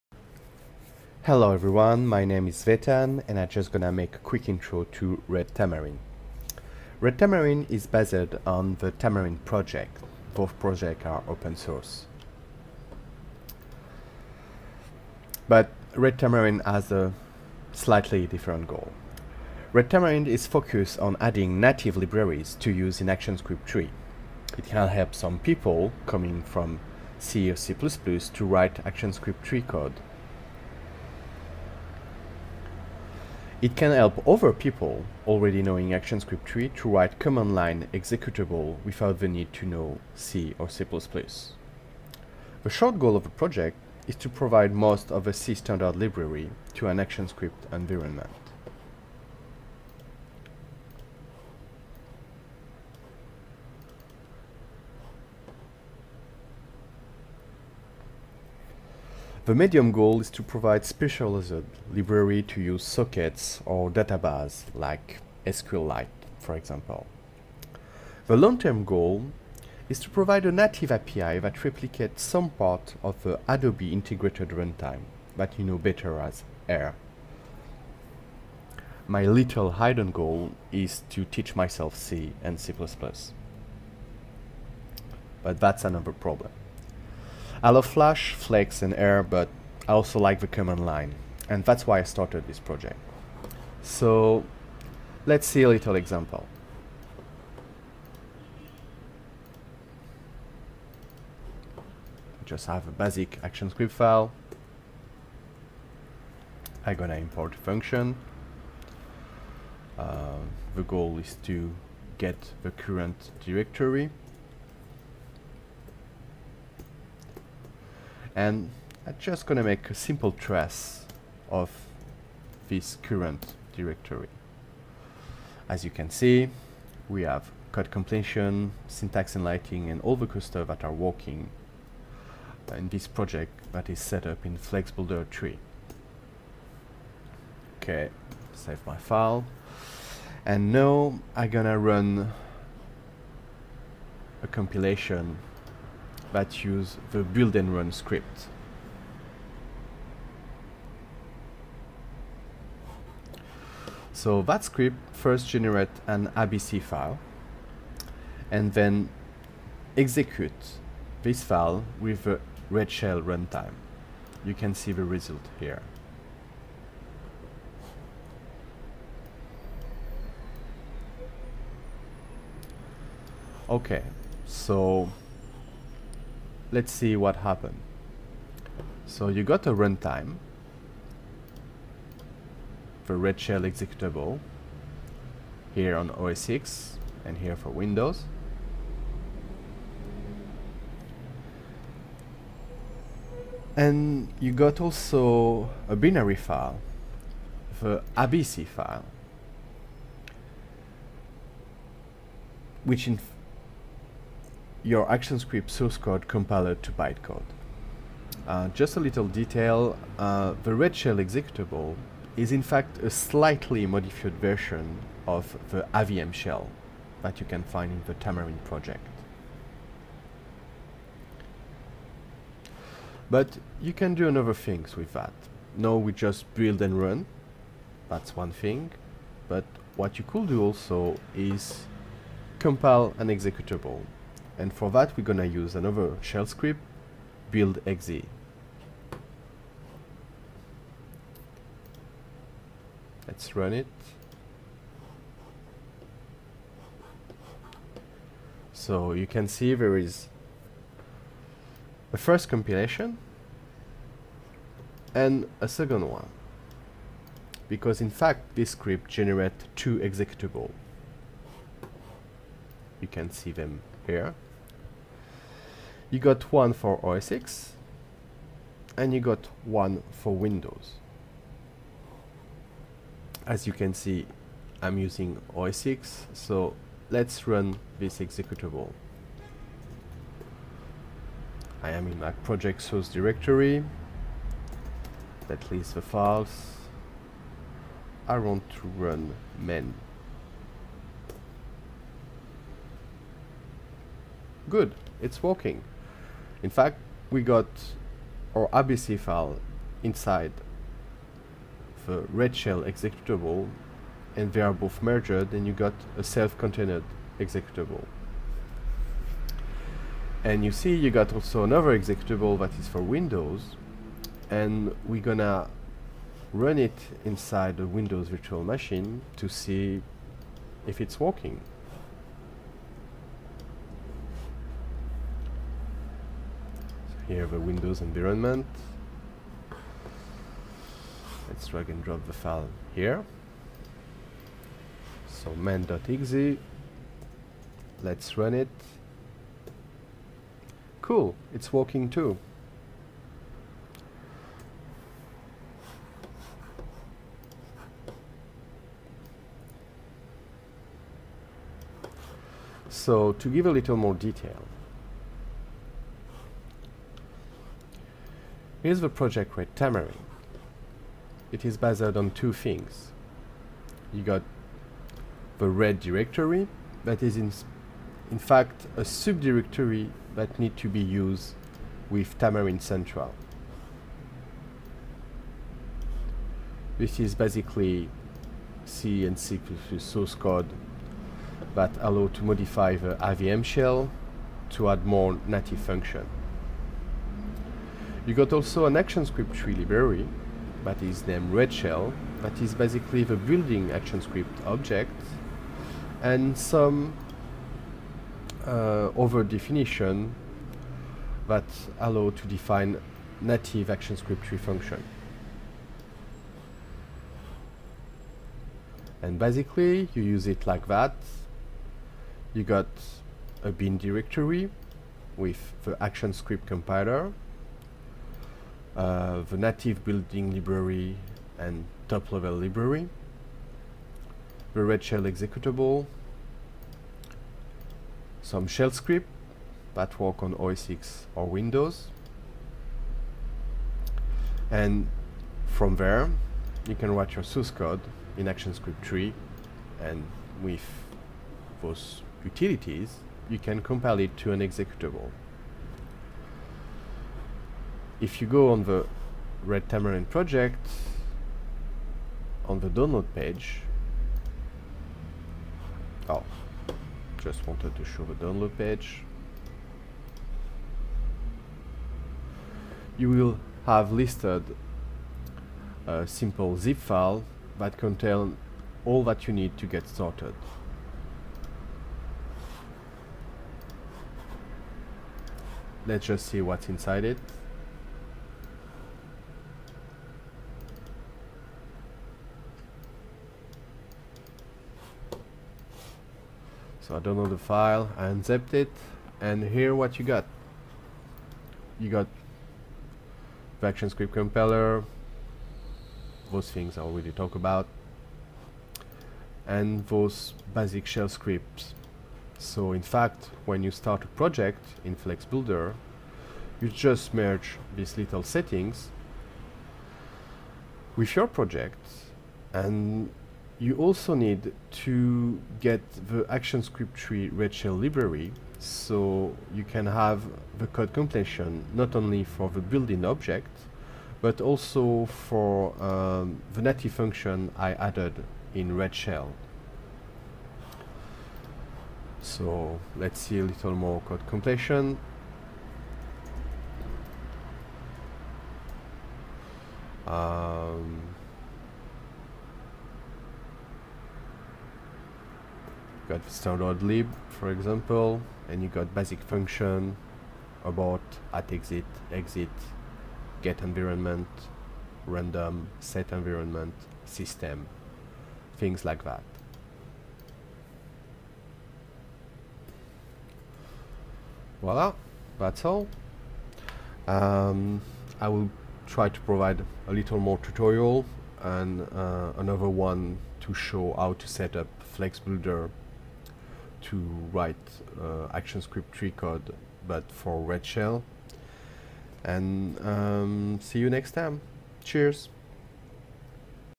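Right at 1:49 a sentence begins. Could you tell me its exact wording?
Uh, the goal is to get the current directory and I'm just gonna make a simple trace of this current directory.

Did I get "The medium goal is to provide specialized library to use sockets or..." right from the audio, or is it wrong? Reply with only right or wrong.
right.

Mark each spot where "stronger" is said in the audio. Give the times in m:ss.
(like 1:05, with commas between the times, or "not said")
not said.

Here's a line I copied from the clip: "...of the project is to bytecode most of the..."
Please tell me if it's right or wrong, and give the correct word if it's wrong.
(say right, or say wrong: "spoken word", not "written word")
wrong: "provide", not "bytecode".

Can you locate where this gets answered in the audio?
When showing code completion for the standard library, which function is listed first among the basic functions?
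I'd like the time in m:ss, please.
9:10.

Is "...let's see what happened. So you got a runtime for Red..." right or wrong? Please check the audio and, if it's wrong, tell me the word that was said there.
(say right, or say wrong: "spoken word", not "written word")
right.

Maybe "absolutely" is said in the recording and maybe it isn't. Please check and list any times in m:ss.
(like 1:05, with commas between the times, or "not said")
not said.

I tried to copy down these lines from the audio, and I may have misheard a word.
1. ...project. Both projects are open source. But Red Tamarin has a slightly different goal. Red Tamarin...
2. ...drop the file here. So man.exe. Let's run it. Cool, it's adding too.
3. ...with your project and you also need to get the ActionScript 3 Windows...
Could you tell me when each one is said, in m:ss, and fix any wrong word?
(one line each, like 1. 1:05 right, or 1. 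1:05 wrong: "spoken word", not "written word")
1. 0:09 right
2. 5:32 wrong: "working", not "adding"
3. 8:31 wrong: "Red", not "Windows".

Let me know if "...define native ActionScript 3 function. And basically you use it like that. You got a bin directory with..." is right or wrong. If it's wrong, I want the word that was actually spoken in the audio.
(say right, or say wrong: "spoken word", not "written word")
right.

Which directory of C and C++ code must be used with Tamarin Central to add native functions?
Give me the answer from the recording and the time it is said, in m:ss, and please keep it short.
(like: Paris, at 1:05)
red directory, at 6:05.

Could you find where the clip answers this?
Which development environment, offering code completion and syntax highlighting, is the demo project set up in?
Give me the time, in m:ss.
2:14.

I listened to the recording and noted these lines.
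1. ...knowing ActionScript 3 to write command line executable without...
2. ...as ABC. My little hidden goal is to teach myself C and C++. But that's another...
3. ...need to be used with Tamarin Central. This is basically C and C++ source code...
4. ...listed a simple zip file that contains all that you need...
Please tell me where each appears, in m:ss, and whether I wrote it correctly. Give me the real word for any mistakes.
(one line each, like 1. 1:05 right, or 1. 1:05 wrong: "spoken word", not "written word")
1. 0:35 right
2. 1:16 wrong: "AIR", not "ABC"
3. 6:10 right
4. 7:44 right.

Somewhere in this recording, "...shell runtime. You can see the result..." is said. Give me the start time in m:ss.
2:42.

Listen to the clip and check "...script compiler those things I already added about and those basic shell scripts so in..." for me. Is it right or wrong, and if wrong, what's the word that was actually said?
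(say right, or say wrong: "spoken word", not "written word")
wrong: "talked", not "added".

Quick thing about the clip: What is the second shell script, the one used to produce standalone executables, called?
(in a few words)
build exe.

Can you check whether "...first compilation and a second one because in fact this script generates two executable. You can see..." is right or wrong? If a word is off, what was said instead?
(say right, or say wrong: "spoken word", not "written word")
right.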